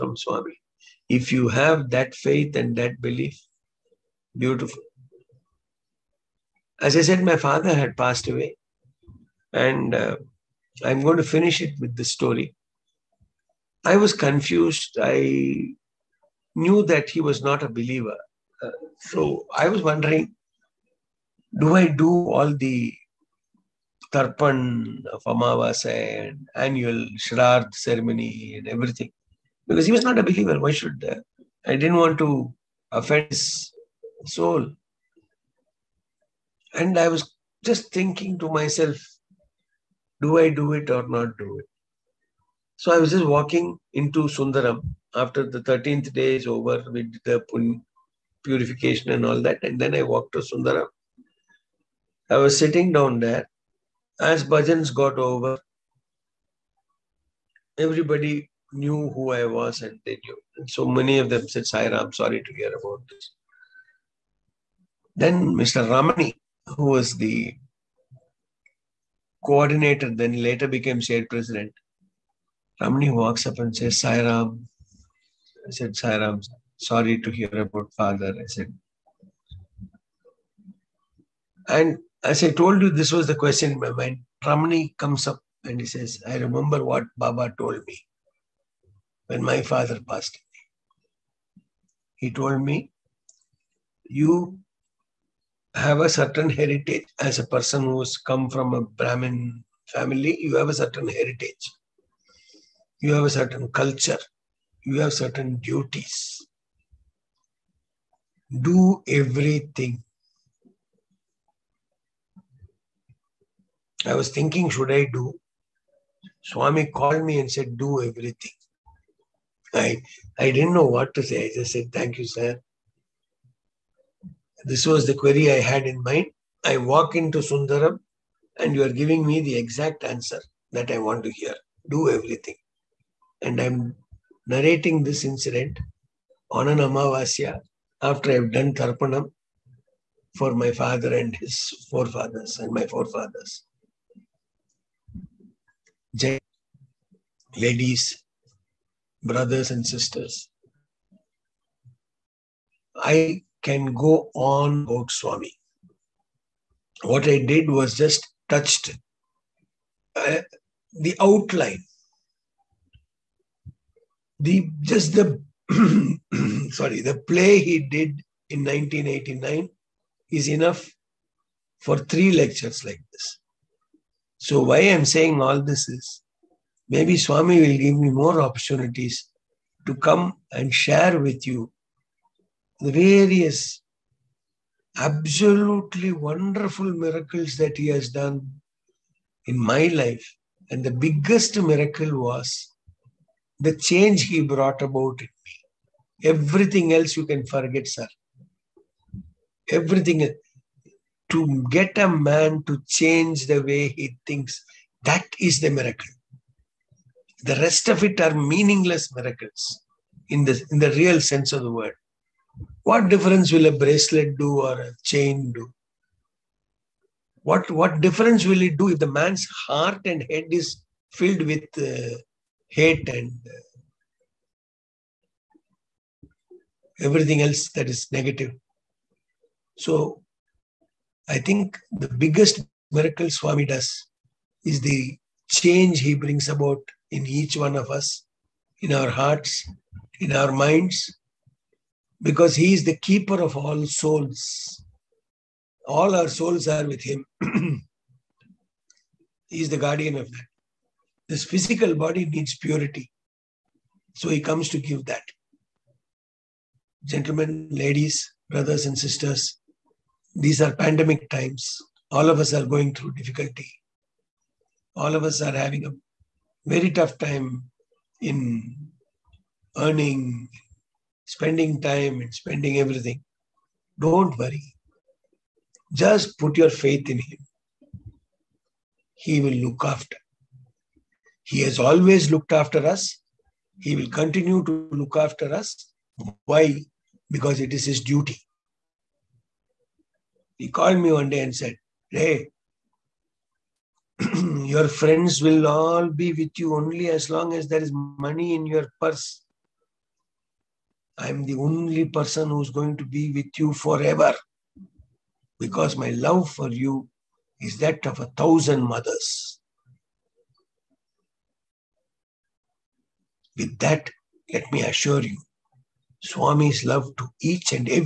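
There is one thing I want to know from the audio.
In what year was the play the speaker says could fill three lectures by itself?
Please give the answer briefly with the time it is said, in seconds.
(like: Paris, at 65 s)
1989, at 168 s.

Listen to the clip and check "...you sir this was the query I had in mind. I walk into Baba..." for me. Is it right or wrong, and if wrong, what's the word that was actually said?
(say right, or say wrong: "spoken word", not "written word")
wrong: "Sundaram", not "Baba".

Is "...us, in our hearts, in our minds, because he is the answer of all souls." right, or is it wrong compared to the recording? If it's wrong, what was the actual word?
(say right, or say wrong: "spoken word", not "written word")
wrong: "keeper", not "answer".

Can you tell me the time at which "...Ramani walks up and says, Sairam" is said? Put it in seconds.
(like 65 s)
72 s.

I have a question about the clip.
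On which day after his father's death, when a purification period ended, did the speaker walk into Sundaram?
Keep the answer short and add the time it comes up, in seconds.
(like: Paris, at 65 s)
13th day, at 45 s.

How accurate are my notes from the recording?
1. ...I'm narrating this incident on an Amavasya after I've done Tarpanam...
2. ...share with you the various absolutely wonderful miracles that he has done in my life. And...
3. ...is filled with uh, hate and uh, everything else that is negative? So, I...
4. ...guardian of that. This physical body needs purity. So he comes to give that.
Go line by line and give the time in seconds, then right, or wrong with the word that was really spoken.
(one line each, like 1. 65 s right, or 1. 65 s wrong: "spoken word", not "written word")
1. 133 s right
2. 180 s right
3. 220 s right
4. 249 s right.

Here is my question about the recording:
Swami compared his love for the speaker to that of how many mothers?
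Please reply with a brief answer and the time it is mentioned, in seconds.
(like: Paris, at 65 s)
1000, at 308 s.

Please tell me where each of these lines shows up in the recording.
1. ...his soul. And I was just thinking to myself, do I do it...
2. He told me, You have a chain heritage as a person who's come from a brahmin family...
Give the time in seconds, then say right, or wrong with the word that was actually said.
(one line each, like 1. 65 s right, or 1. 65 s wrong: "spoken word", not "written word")
1. 33 s right
2. 92 s wrong: "certain", not "chain".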